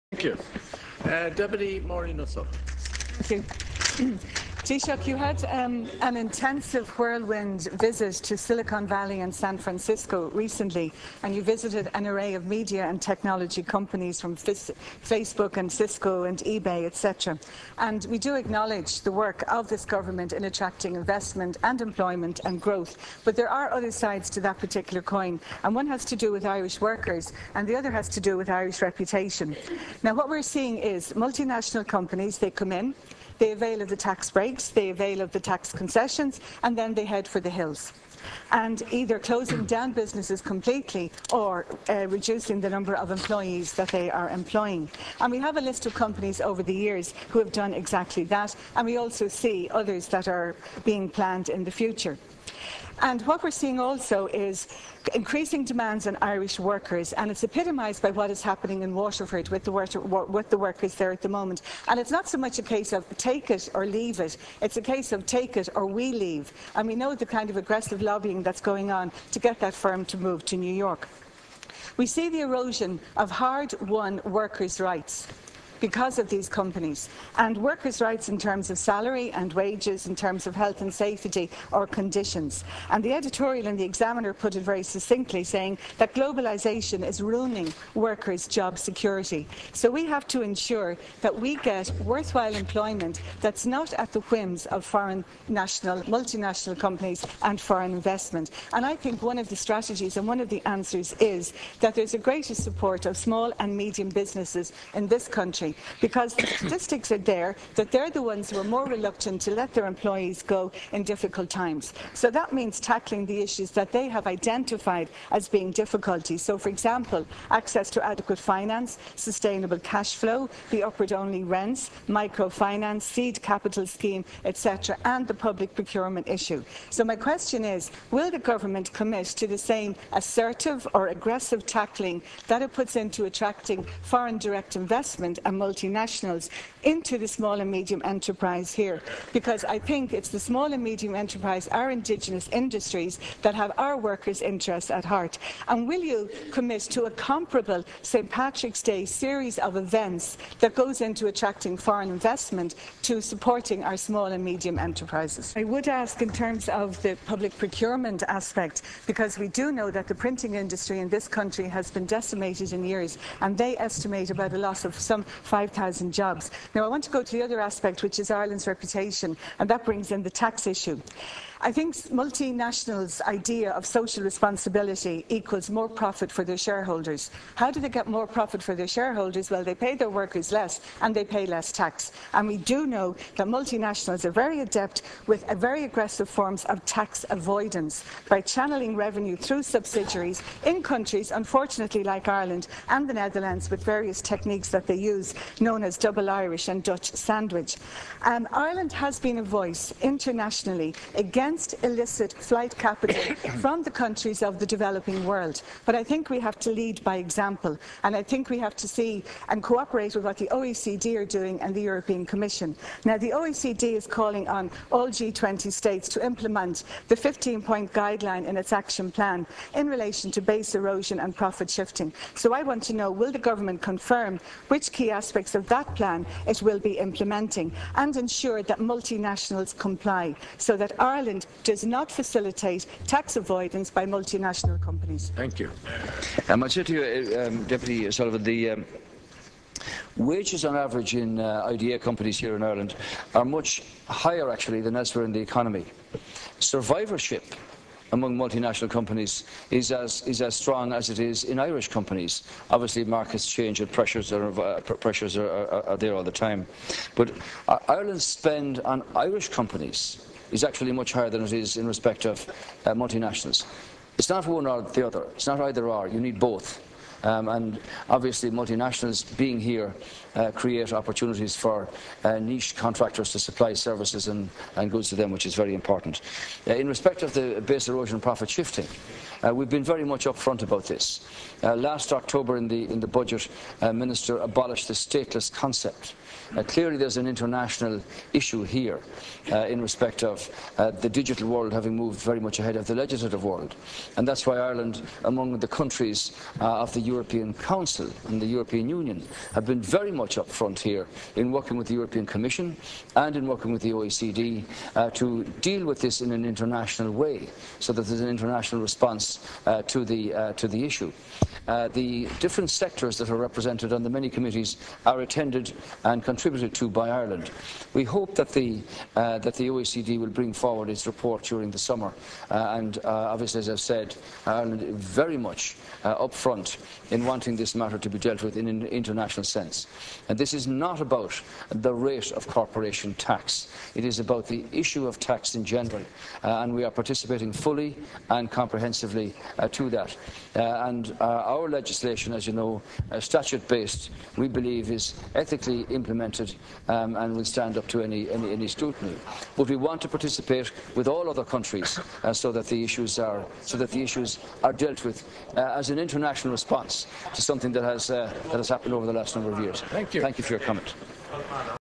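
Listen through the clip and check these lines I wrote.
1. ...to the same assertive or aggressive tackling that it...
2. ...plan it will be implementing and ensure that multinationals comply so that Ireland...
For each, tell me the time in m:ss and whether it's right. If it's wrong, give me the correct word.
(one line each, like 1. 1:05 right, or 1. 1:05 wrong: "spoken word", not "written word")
1. 2:09 right
2. 3:45 right.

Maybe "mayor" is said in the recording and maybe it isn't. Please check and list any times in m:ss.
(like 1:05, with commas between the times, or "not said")
not said.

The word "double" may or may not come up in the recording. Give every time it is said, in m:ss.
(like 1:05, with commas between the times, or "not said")
3:15.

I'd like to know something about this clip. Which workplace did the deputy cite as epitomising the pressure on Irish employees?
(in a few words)
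Waterford.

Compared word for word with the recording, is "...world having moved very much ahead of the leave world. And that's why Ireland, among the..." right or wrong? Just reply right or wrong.
wrong.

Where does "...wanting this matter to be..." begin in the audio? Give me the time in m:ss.
5:27.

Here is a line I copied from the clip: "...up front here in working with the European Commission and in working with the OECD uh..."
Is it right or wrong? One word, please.
right.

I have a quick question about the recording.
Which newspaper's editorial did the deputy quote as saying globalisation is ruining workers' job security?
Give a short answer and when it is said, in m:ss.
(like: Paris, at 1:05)
The Examiner, at 1:23.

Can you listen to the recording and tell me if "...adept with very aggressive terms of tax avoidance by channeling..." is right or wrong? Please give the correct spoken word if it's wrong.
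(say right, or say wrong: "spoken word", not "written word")
wrong: "forms", not "terms".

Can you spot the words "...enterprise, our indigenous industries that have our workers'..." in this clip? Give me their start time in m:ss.
2:21.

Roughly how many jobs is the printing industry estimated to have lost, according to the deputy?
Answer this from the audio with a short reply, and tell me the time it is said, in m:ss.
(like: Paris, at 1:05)
5,000, at 2:45.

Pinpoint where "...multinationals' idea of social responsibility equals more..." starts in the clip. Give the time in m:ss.
2:52.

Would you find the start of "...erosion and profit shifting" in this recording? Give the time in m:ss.
3:40.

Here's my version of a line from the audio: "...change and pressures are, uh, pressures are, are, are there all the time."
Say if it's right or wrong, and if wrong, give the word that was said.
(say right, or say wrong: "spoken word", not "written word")
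right.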